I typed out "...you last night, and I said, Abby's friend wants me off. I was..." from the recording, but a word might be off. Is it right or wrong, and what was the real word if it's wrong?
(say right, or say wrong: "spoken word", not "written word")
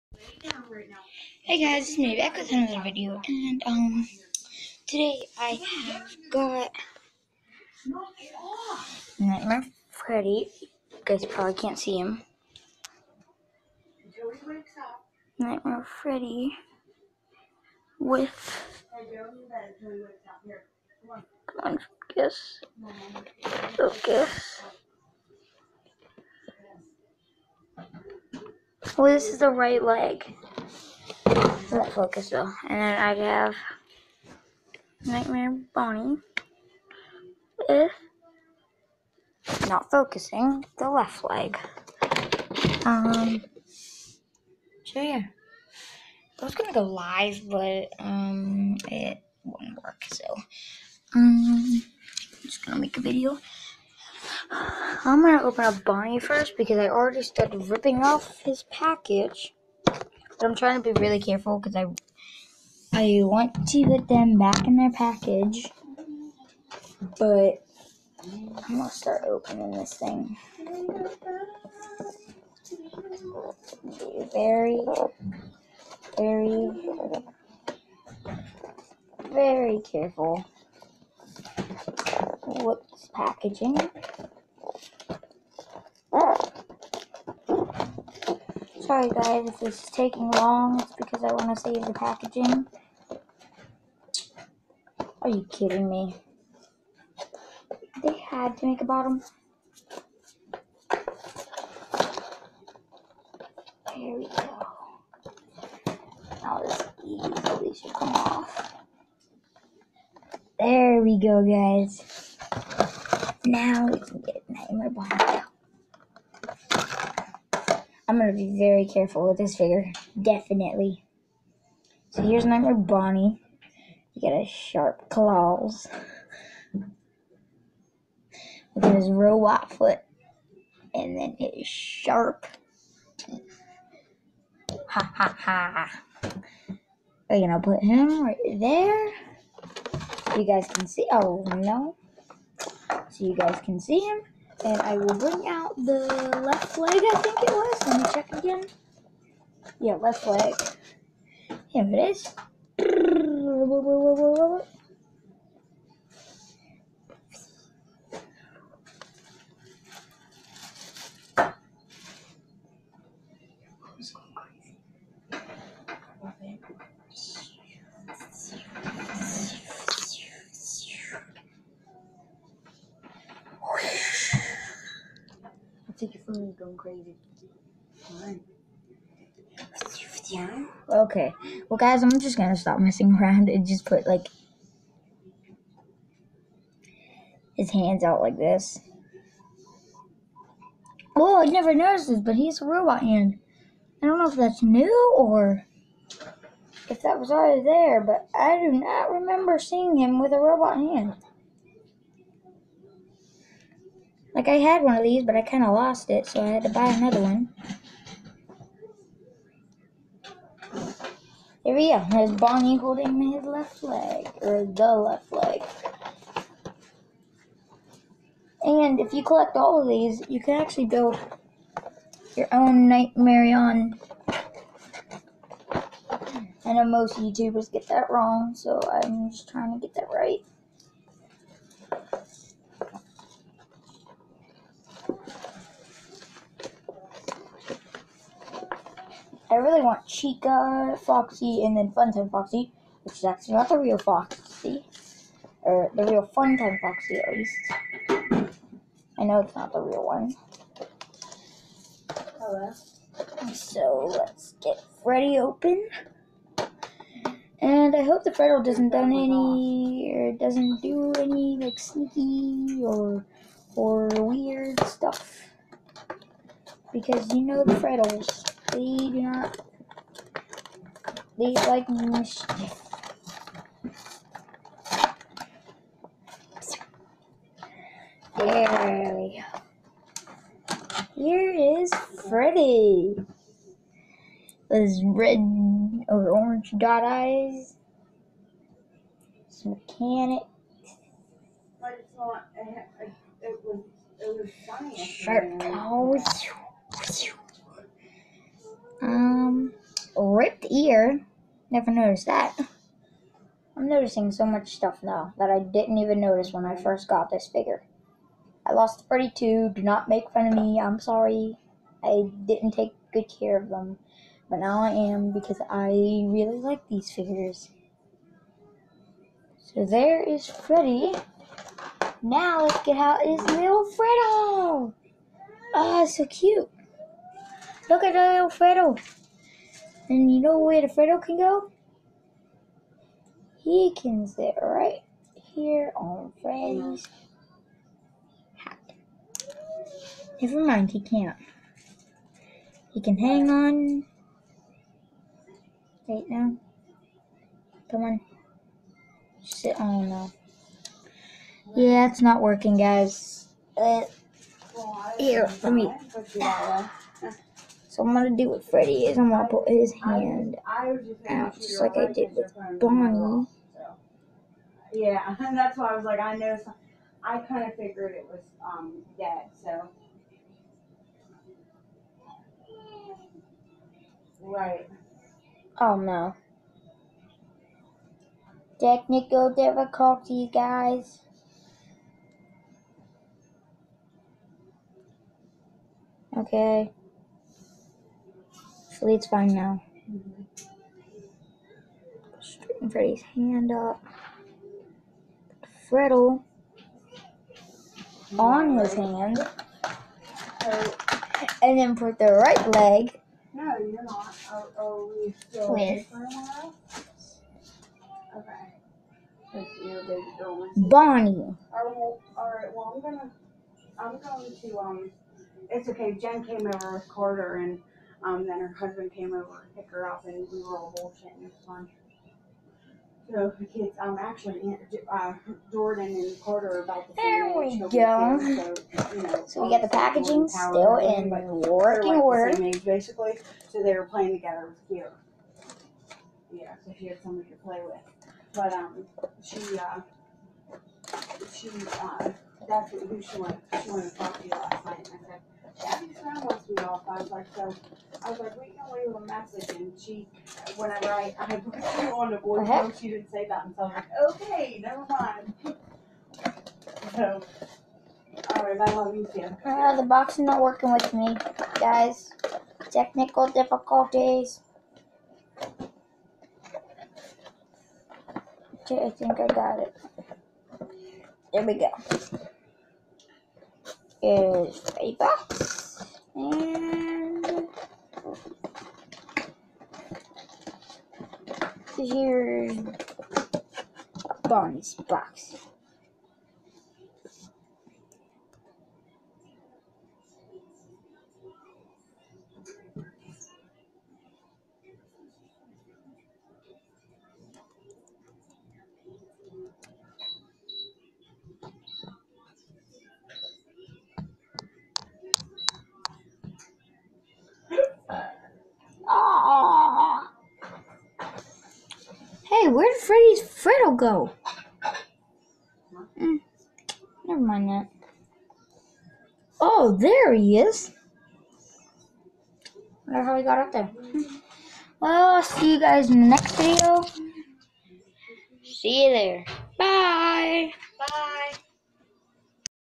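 right.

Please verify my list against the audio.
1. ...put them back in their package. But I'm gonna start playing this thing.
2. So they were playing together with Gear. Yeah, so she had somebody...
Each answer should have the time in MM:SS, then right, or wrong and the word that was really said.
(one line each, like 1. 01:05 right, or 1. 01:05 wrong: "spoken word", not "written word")
1. 01:03 wrong: "opening", not "playing"
2. 07:13 right.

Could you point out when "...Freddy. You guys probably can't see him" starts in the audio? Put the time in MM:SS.
00:09.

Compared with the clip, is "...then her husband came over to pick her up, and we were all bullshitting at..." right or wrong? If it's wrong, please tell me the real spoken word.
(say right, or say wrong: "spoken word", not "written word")
right.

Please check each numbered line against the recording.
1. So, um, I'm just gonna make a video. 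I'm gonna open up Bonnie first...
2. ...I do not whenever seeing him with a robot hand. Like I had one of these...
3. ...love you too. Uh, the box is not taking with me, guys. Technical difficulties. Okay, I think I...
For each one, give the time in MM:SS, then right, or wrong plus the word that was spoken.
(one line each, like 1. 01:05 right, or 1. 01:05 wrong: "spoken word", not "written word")
1. 00:50 right
2. 03:18 wrong: "remember", not "whenever"
3. 07:38 wrong: "working", not "taking".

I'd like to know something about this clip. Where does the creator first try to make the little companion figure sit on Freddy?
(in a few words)
Freddy's hat.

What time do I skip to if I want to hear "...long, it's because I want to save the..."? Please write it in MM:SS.
01:30.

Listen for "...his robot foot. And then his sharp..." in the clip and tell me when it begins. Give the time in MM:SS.
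02:08.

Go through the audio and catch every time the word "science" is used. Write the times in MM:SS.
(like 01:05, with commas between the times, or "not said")
04:54.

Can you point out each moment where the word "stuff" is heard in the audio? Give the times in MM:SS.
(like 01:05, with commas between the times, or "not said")
04:24, 05:04.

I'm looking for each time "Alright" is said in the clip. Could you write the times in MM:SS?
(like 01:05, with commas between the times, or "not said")
06:51, 07:38.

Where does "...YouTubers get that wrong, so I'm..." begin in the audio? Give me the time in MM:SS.
03:47.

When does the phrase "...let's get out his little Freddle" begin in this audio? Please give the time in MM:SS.
05:22.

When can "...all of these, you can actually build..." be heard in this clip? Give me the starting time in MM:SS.
03:39.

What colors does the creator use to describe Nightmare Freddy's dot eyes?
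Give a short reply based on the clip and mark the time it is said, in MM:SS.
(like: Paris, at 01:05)
Red or orange, at 04:45.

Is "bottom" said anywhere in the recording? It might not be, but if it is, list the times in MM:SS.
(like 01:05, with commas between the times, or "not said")
01:38, 01:54.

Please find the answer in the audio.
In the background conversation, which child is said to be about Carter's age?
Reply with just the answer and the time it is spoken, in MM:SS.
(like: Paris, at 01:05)
Jordan, at 07:05.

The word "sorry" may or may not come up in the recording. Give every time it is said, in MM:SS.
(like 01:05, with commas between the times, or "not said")
01:28, 05:10.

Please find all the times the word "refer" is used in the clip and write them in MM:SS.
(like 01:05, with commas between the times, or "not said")
not said.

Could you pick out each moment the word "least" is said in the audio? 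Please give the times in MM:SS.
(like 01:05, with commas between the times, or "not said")
04:07.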